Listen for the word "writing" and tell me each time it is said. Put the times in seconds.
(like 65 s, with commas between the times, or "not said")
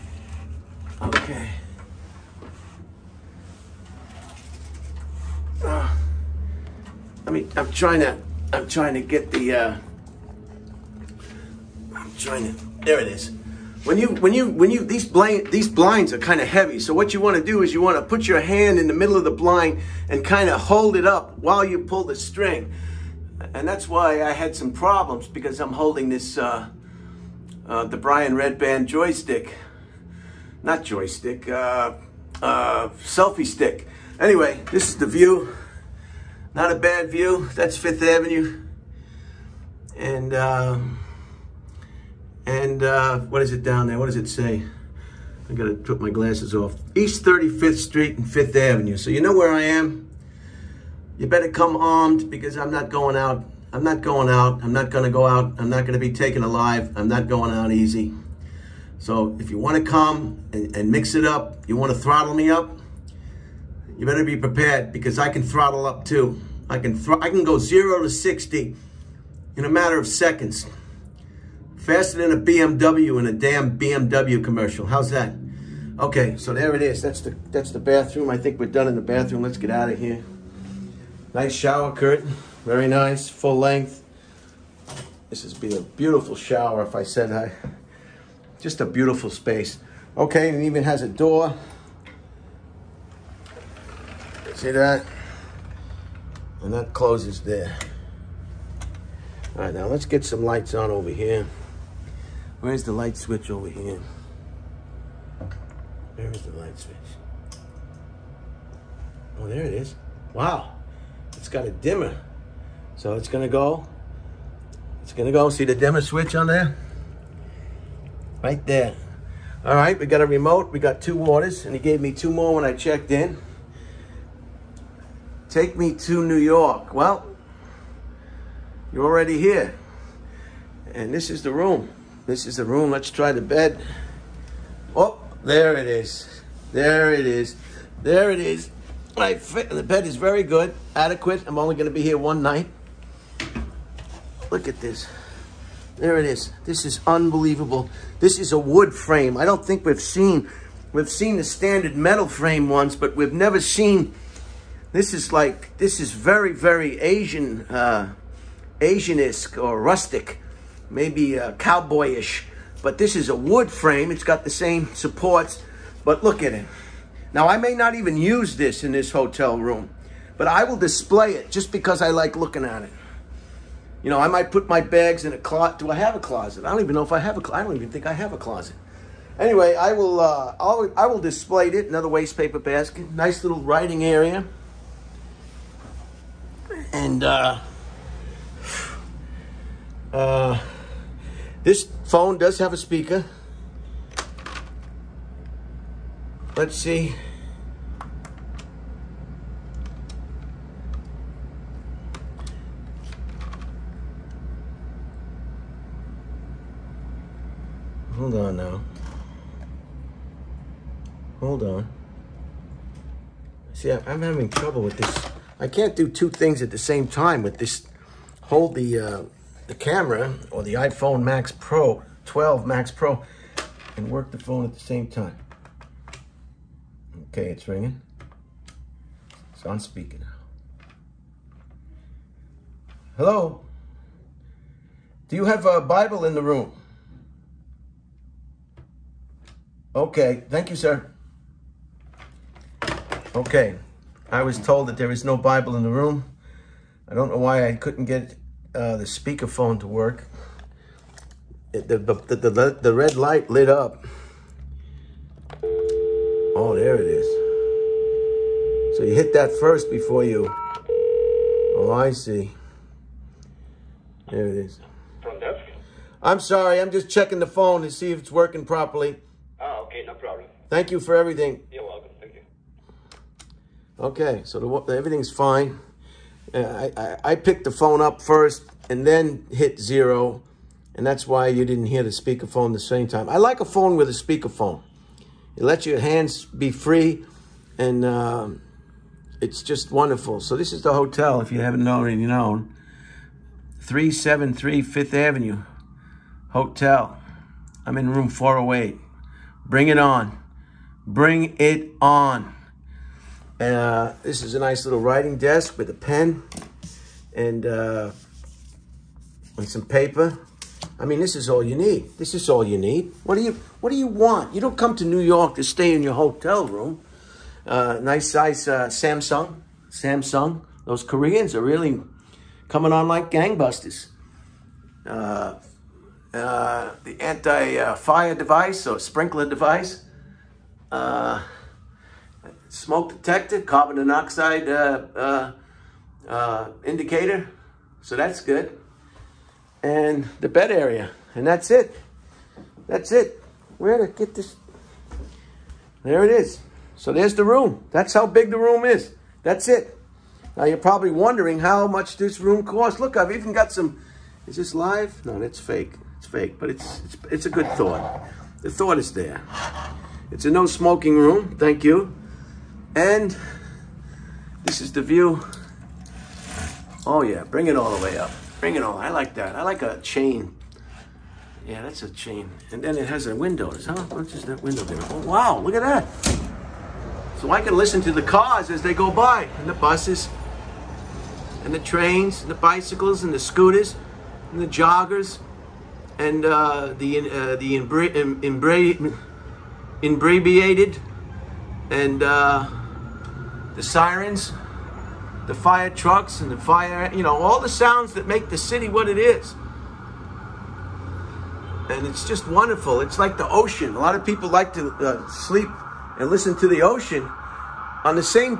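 183 s, 304 s.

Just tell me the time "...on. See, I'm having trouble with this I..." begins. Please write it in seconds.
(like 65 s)
211 s.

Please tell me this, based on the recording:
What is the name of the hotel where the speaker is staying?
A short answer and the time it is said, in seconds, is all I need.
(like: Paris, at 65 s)
373 Fifth Avenue Hotel, at 293 s.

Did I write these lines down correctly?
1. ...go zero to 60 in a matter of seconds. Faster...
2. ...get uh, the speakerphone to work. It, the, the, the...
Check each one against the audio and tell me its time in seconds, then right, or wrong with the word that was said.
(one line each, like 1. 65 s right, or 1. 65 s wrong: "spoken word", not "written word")
1. 67 s right
2. 248 s right.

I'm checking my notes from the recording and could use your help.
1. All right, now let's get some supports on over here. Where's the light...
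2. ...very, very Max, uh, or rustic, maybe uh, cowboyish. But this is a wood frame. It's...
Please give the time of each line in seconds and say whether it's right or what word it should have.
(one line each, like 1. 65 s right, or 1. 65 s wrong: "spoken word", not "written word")
1. 99 s wrong: "lights", not "supports"
2. 156 s wrong: "Asian", not "Max".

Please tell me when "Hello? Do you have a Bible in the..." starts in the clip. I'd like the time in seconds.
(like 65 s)
233 s.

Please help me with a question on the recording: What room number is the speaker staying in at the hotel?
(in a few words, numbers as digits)
408.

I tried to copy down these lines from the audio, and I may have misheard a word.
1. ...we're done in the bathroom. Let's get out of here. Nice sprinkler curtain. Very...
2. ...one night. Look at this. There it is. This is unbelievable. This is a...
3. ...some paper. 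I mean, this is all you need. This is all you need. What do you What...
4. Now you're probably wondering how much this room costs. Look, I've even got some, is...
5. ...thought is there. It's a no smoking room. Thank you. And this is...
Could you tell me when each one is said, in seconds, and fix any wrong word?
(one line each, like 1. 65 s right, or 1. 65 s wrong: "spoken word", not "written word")
1. 78 s wrong: "shower", not "sprinkler"
2. 142 s right
3. 309 s right
4. 350 s right
5. 358 s right.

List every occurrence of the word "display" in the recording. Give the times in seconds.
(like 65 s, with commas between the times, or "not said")
170 s, 181 s.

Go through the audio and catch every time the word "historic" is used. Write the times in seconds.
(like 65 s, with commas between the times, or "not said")
not said.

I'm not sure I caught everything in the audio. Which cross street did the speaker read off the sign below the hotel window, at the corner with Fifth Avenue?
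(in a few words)
East 35th Street.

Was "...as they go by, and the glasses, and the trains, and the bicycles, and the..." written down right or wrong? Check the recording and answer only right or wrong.
wrong.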